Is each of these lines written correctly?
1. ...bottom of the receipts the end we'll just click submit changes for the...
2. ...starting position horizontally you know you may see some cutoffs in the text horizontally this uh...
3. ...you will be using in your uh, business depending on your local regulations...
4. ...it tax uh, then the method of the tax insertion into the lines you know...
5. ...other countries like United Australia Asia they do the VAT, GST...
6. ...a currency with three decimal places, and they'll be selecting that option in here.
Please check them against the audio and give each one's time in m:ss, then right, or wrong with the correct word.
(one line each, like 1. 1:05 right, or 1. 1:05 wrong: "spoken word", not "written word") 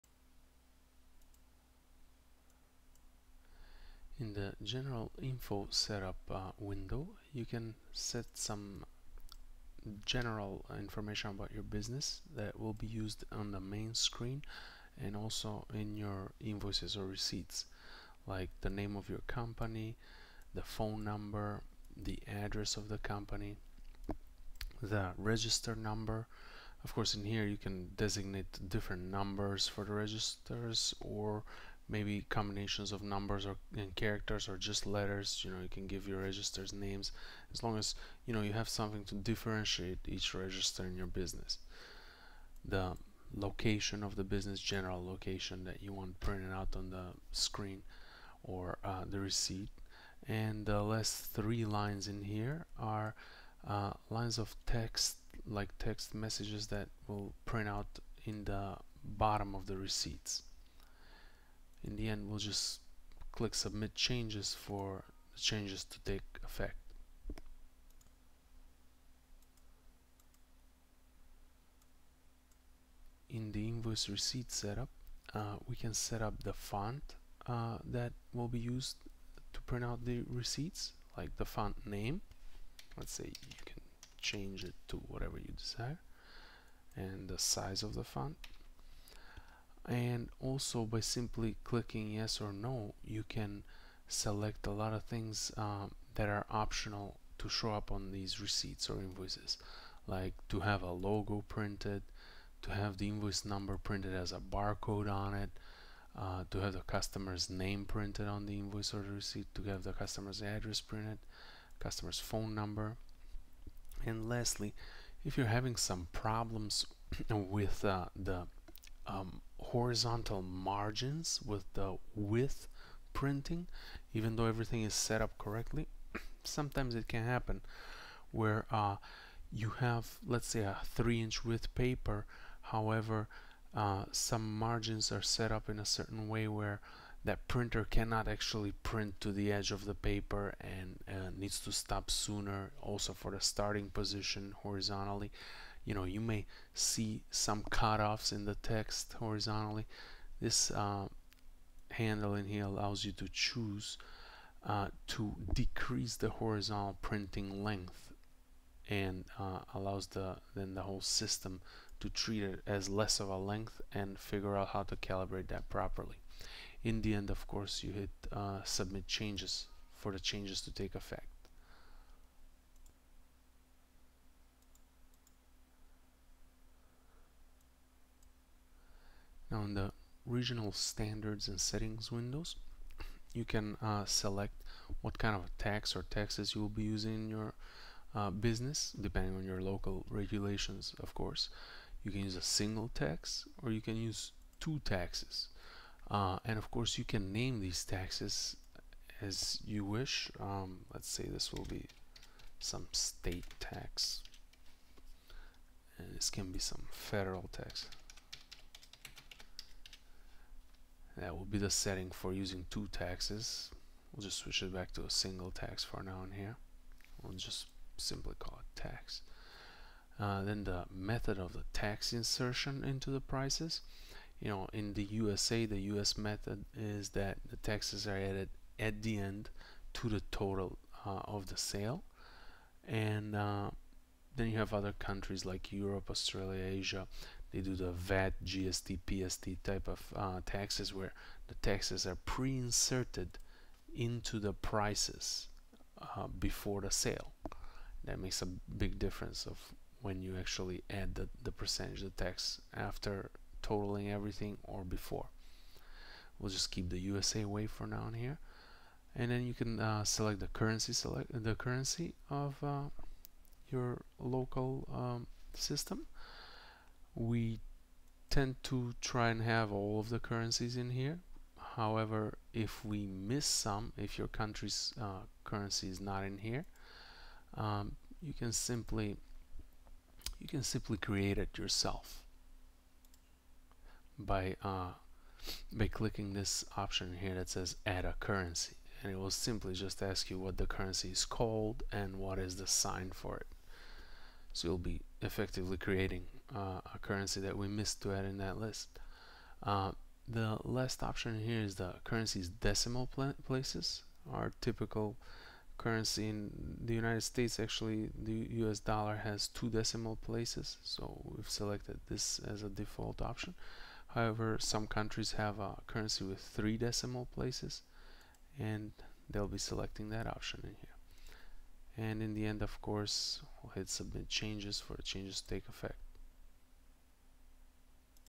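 1. 0:59 right
2. 2:23 right
3. 3:06 right
4. 3:38 wrong: "prices", not "lines"
5. 3:54 wrong: "Europe", not "United"
6. 5:15 right.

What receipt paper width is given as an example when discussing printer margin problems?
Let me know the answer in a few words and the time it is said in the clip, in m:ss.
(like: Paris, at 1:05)
3 inch, at 2:10.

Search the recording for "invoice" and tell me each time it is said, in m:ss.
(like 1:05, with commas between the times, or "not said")
0:16, 1:13, 1:38, 1:43, 1:48.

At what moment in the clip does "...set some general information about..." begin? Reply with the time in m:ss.
0:07.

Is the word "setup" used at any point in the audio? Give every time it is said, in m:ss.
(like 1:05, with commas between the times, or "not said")
0:05, 1:14.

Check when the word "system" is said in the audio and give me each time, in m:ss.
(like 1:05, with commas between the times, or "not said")
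2:41, 4:25.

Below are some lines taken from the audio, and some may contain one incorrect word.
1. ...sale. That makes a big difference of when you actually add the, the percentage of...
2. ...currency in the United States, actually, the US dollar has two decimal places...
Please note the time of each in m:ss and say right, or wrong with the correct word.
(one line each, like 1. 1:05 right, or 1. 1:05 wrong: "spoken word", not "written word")
1. 4:06 right
2. 5:05 right.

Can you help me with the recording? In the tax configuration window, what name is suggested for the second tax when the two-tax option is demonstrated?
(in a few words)
federal tax.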